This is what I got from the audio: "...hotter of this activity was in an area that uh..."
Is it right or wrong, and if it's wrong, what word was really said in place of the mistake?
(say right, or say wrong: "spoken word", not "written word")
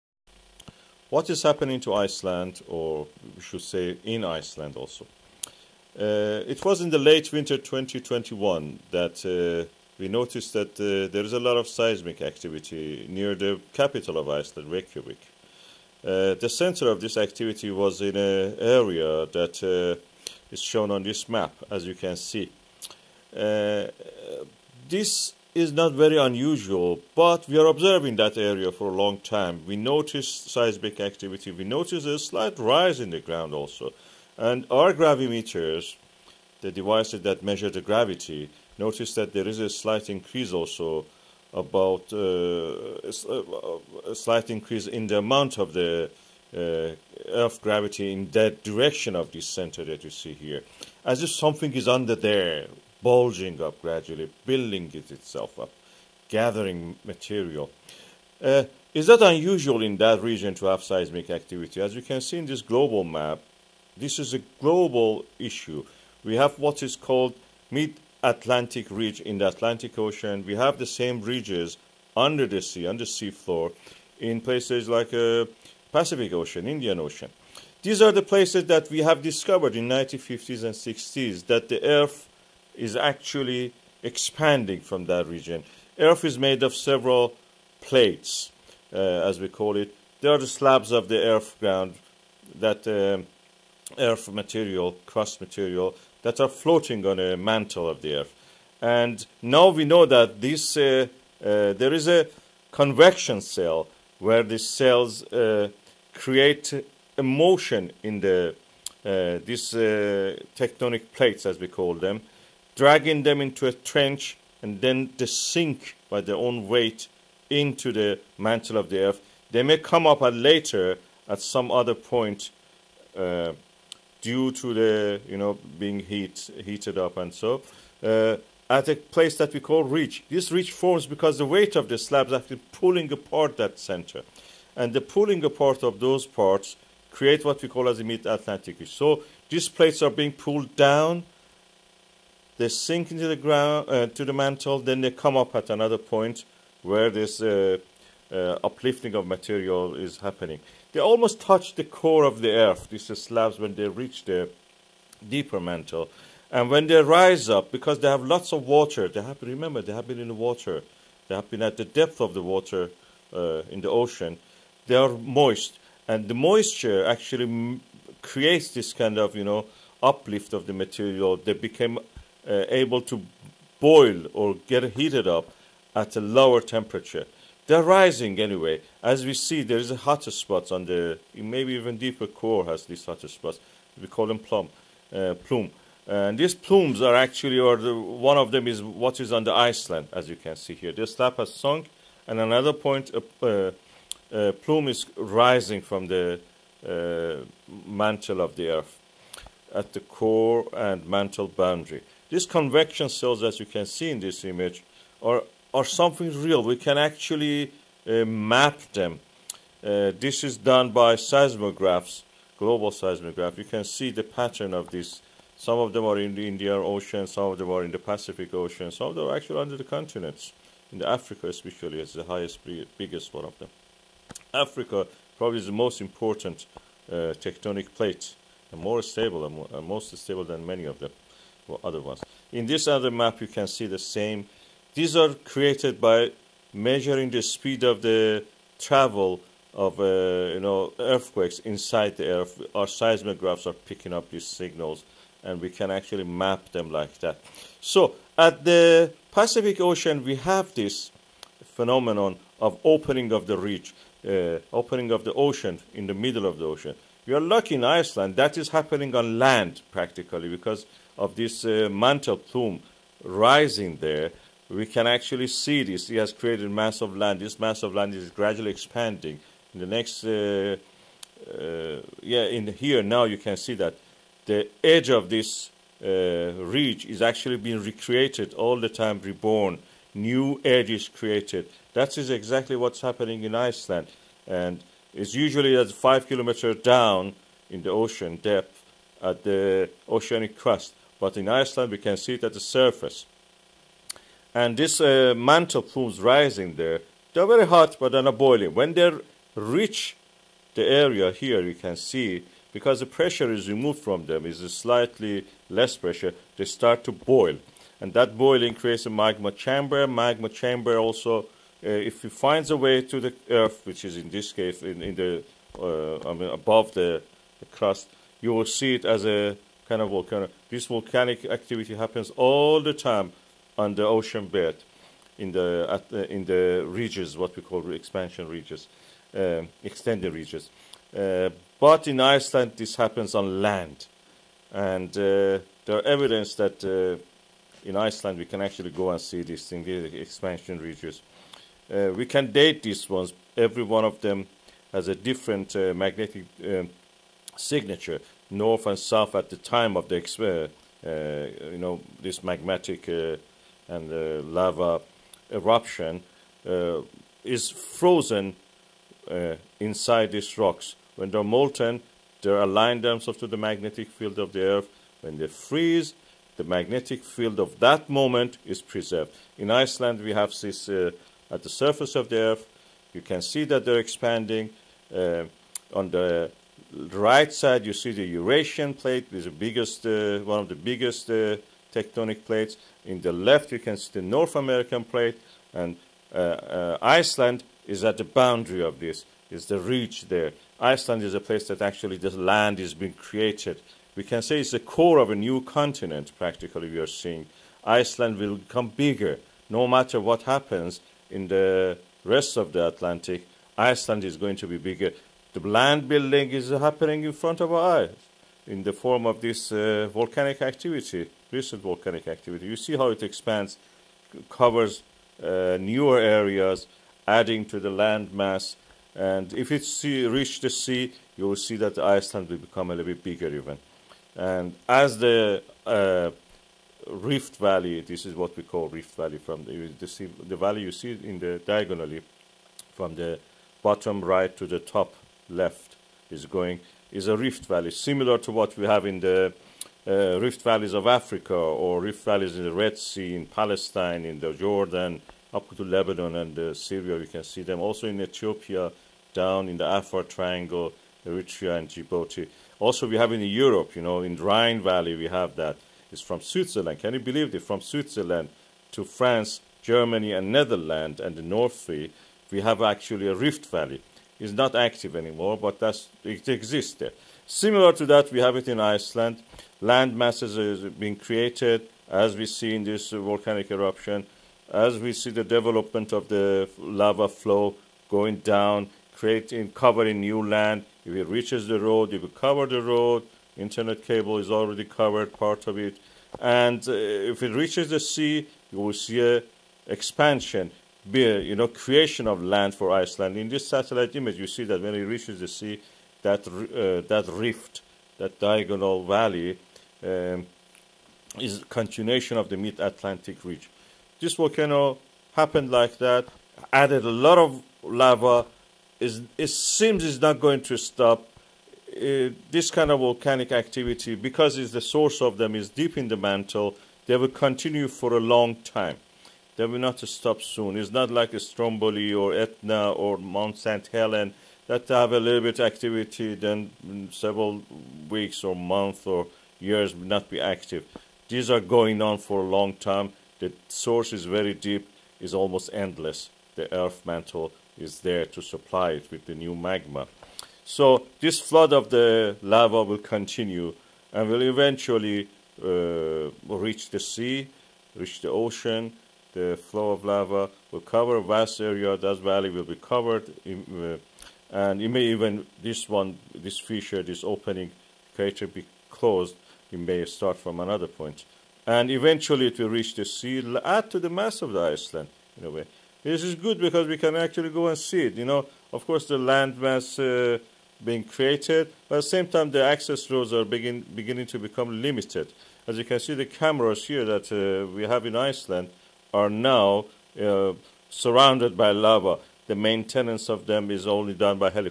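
wrong: "center", not "hotter".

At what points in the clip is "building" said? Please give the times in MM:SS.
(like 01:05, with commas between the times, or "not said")
00:54, 06:46.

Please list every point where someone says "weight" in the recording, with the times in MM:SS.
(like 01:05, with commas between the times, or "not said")
01:56, 02:11.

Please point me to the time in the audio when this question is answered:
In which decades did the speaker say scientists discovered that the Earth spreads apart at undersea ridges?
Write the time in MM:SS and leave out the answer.
01:19.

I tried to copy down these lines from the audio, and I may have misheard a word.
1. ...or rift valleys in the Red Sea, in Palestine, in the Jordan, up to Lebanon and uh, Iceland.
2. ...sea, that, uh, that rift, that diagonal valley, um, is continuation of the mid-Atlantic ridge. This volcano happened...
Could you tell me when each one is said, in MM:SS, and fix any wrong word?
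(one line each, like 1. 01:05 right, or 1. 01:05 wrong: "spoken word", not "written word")
1. 07:21 wrong: "Syria", not "Iceland"
2. 08:15 right.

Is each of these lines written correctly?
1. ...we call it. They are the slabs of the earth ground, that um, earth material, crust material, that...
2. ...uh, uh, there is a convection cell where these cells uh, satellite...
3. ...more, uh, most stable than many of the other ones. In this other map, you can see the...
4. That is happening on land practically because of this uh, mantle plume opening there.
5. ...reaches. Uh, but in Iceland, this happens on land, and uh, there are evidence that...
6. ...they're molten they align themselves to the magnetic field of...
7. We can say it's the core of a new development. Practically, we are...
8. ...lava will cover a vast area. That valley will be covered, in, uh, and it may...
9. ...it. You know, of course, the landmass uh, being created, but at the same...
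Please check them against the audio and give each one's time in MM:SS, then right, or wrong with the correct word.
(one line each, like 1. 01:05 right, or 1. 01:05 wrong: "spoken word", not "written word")
1. 01:29 right
2. 01:40 wrong: "create", not "satellite"
3. 03:49 right
4. 04:18 wrong: "rising", not "opening"
5. 05:30 wrong: "ridges", not "reaches"
6. 06:01 right
7. 06:34 wrong: "continent", not "development"
8. 09:10 right
9. 09:28 right.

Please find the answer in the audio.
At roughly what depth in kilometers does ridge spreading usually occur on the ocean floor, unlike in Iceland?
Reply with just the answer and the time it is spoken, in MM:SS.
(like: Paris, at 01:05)
5 kilometers, at 04:45.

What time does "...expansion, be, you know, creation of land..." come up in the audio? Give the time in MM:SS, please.
08:09.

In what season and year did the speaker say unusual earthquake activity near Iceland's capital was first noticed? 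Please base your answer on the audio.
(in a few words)
Late winter 2021.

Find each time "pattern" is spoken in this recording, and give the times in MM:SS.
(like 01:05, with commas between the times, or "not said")
03:34.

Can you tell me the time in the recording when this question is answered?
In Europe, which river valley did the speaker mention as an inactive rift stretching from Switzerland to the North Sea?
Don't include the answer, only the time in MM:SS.
07:34.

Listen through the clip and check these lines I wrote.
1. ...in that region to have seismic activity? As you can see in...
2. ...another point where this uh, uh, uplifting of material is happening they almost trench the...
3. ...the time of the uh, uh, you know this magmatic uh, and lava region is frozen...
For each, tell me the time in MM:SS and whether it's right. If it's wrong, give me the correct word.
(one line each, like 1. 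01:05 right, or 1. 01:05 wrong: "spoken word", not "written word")
1. 00:59 right
2. 02:25 wrong: "touch", not "trench"
3. 05:49 wrong: "eruption", not "region".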